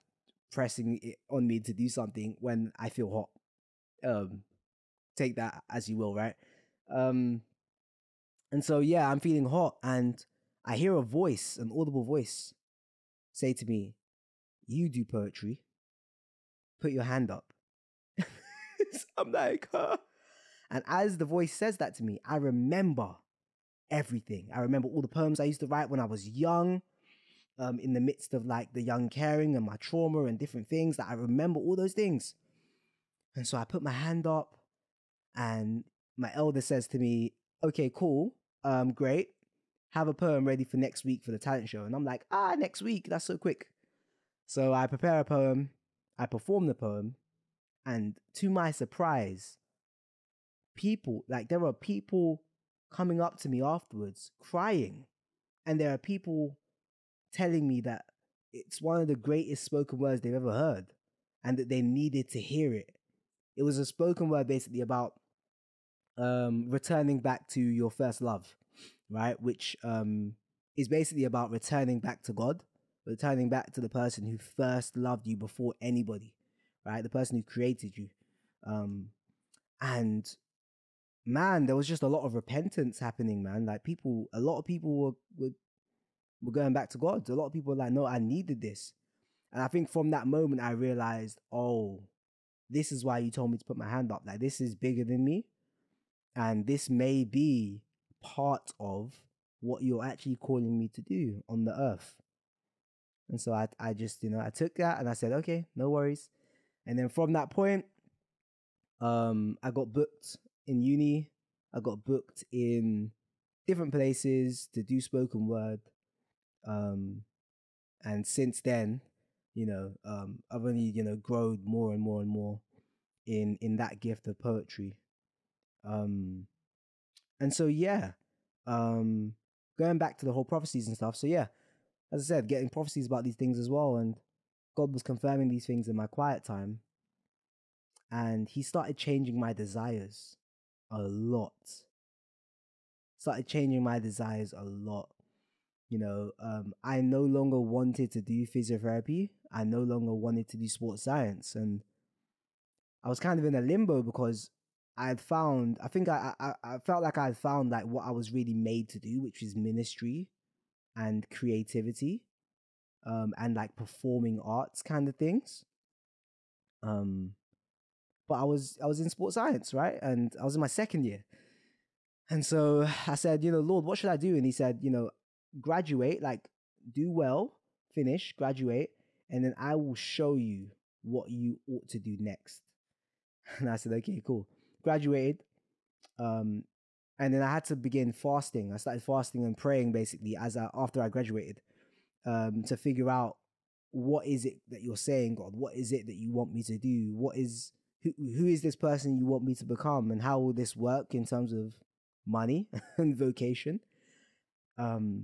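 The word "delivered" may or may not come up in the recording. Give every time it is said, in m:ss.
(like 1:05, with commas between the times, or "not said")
not said.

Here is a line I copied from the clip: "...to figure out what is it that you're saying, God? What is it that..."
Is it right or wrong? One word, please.
right.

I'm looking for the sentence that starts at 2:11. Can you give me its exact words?
So yeah, as I said, getting prophecies about these things as well, and God was confirming these things in my quiet time.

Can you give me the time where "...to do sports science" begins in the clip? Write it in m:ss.
2:30.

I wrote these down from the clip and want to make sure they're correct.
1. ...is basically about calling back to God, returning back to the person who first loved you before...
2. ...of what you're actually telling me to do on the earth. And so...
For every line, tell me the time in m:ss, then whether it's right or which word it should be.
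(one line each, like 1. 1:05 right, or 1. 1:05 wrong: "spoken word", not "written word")
1. 1:10 wrong: "returning", not "calling"
2. 1:38 wrong: "calling", not "telling".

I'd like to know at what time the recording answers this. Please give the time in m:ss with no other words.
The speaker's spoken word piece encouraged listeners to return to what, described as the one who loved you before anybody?
1:07.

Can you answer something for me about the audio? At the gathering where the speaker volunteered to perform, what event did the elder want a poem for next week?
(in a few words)
talent show.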